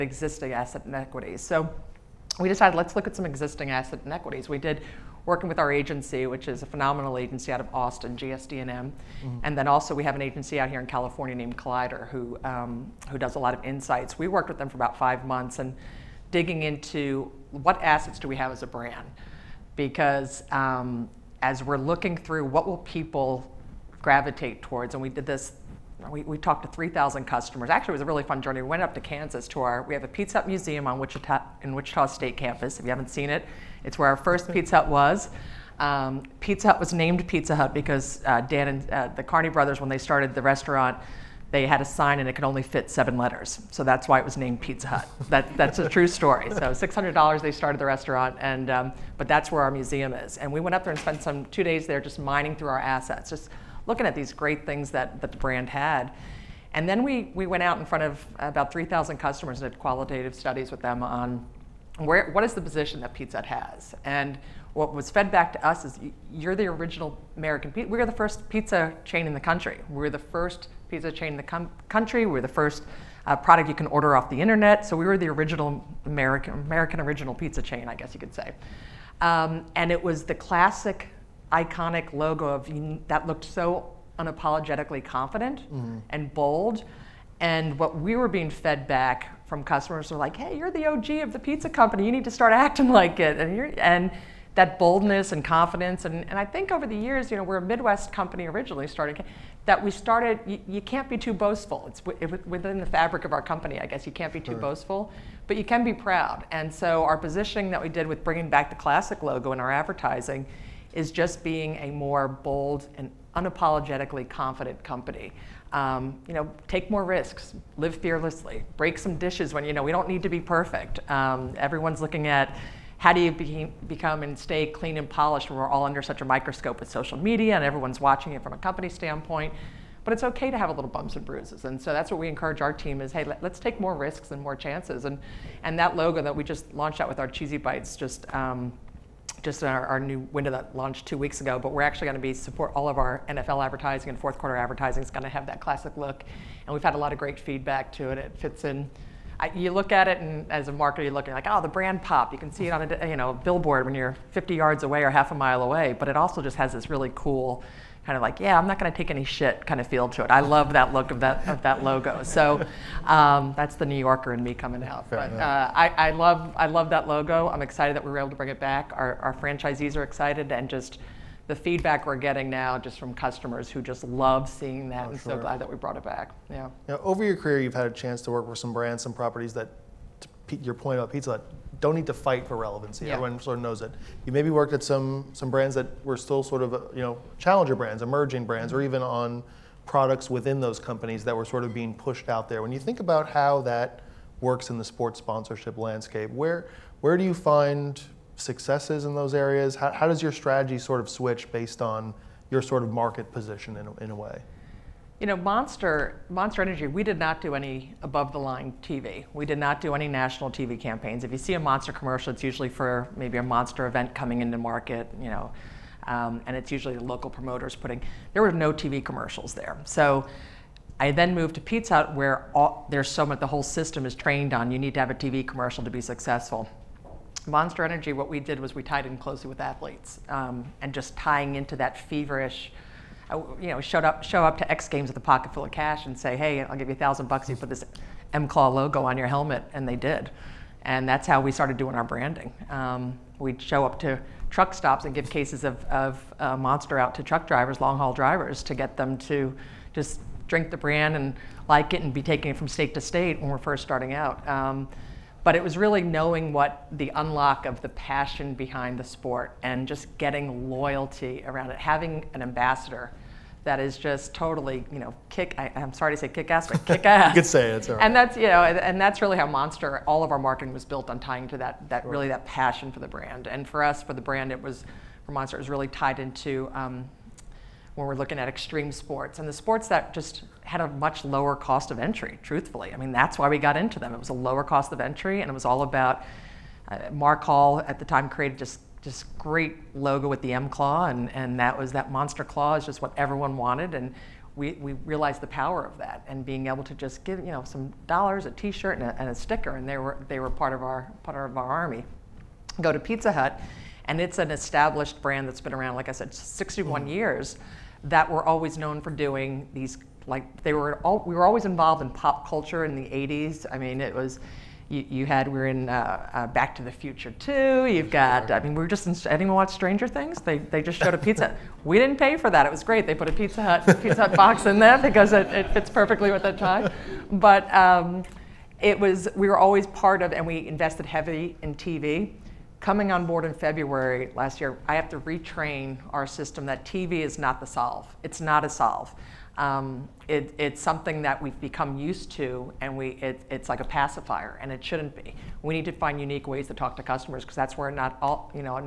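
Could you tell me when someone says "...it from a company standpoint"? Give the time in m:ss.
2:08.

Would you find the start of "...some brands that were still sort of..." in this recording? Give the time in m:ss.
3:05.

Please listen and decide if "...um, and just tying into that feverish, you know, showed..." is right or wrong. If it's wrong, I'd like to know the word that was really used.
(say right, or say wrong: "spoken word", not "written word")
right.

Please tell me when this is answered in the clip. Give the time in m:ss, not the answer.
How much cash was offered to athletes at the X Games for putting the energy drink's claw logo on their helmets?
3:56.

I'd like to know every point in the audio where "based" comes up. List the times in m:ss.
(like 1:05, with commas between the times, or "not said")
3:21.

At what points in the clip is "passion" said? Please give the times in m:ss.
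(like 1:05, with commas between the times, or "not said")
4:17, 4:32.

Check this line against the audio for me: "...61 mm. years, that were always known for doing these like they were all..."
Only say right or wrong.
right.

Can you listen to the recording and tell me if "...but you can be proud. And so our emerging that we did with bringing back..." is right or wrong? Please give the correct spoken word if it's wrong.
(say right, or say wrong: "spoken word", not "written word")
wrong: "positioning", not "emerging".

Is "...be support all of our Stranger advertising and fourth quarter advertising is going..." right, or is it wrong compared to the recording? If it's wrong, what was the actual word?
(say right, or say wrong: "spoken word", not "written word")
wrong: "NFL", not "Stranger".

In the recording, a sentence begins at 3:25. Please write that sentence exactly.
You know, Monster, Monster Energy, we did not do any above the line TV.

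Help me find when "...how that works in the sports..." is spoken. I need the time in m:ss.
3:13.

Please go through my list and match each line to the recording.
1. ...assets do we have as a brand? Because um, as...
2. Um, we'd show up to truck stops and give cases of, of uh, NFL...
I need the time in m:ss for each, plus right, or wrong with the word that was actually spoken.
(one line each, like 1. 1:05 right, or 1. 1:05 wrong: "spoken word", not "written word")
1. 0:17 right
2. 4:02 wrong: "Monster", not "NFL".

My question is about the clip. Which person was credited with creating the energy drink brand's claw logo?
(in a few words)
Mark Hall.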